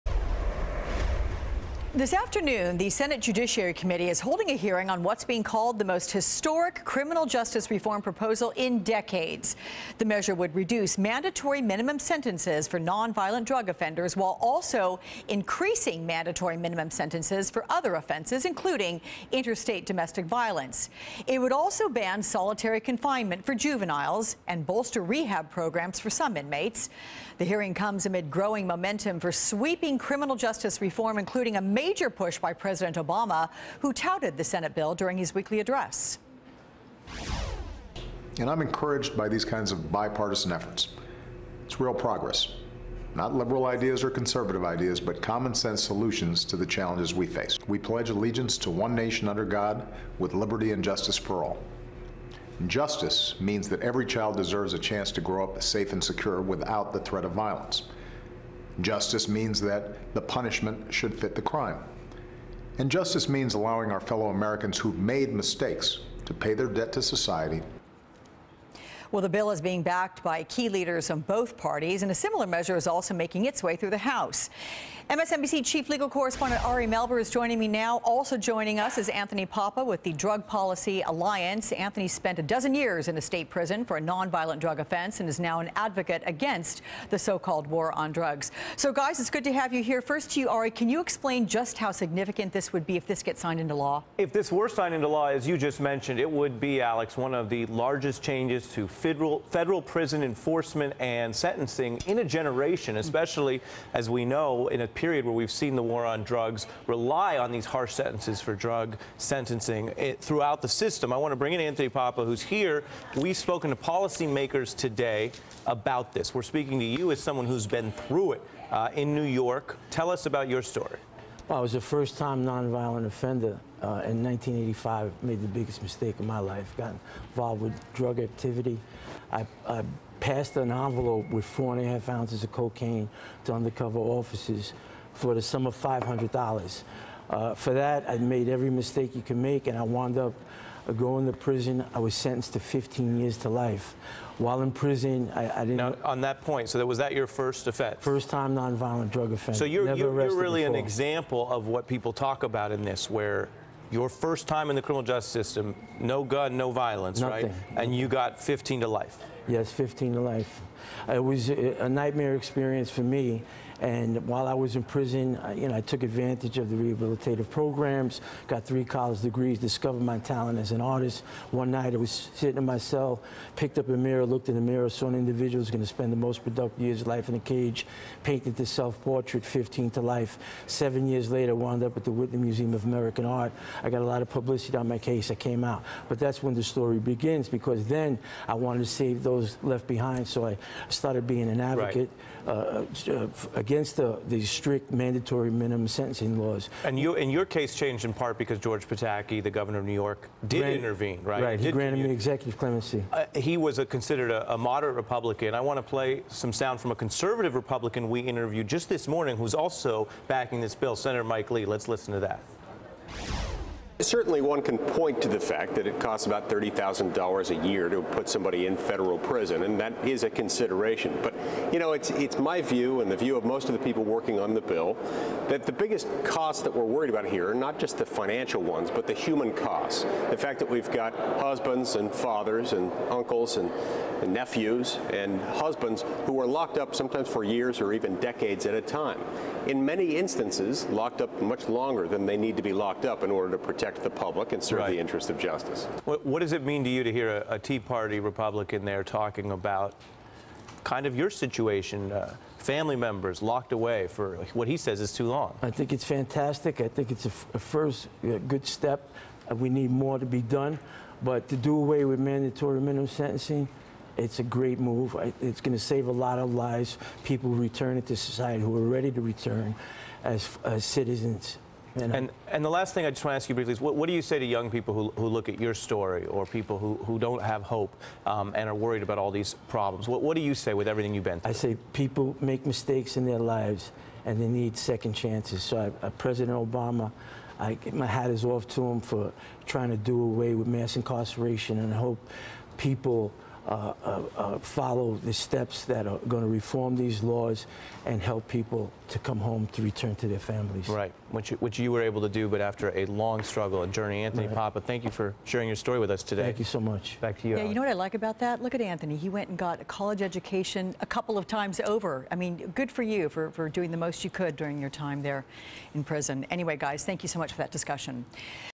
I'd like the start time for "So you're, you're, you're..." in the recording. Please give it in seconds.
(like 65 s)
149 s.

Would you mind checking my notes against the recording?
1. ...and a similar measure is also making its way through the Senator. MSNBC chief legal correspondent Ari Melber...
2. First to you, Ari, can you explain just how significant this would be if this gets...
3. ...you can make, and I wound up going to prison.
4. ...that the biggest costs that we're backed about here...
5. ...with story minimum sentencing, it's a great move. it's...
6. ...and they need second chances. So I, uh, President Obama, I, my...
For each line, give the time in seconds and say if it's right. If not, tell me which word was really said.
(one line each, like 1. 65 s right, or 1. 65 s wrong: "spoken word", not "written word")
1. 72 s wrong: "House", not "Senator"
2. 90 s right
3. 139 s right
4. 225 s wrong: "worried", not "backed"
5. 262 s wrong: "mandatory", not "story"
6. 284 s right.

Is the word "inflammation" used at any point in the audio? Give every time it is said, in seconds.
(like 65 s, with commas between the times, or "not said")
not said.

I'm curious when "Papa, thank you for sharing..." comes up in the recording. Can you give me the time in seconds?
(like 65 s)
304 s.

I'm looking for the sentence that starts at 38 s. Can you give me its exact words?
And I'm encouraged by these kinds of bipartisan efforts.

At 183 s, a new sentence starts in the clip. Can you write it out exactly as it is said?
I got a lot of publicity on my case.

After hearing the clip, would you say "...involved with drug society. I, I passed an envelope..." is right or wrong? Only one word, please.
wrong.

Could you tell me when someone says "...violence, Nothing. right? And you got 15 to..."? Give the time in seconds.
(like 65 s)
156 s.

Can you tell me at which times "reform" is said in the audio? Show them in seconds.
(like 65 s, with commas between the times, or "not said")
7 s, 30 s, 296 s.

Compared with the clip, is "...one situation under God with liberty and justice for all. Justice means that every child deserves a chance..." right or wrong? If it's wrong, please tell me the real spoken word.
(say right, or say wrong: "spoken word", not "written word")
wrong: "nation", not "situation".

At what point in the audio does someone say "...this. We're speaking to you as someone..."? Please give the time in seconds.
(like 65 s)
116 s.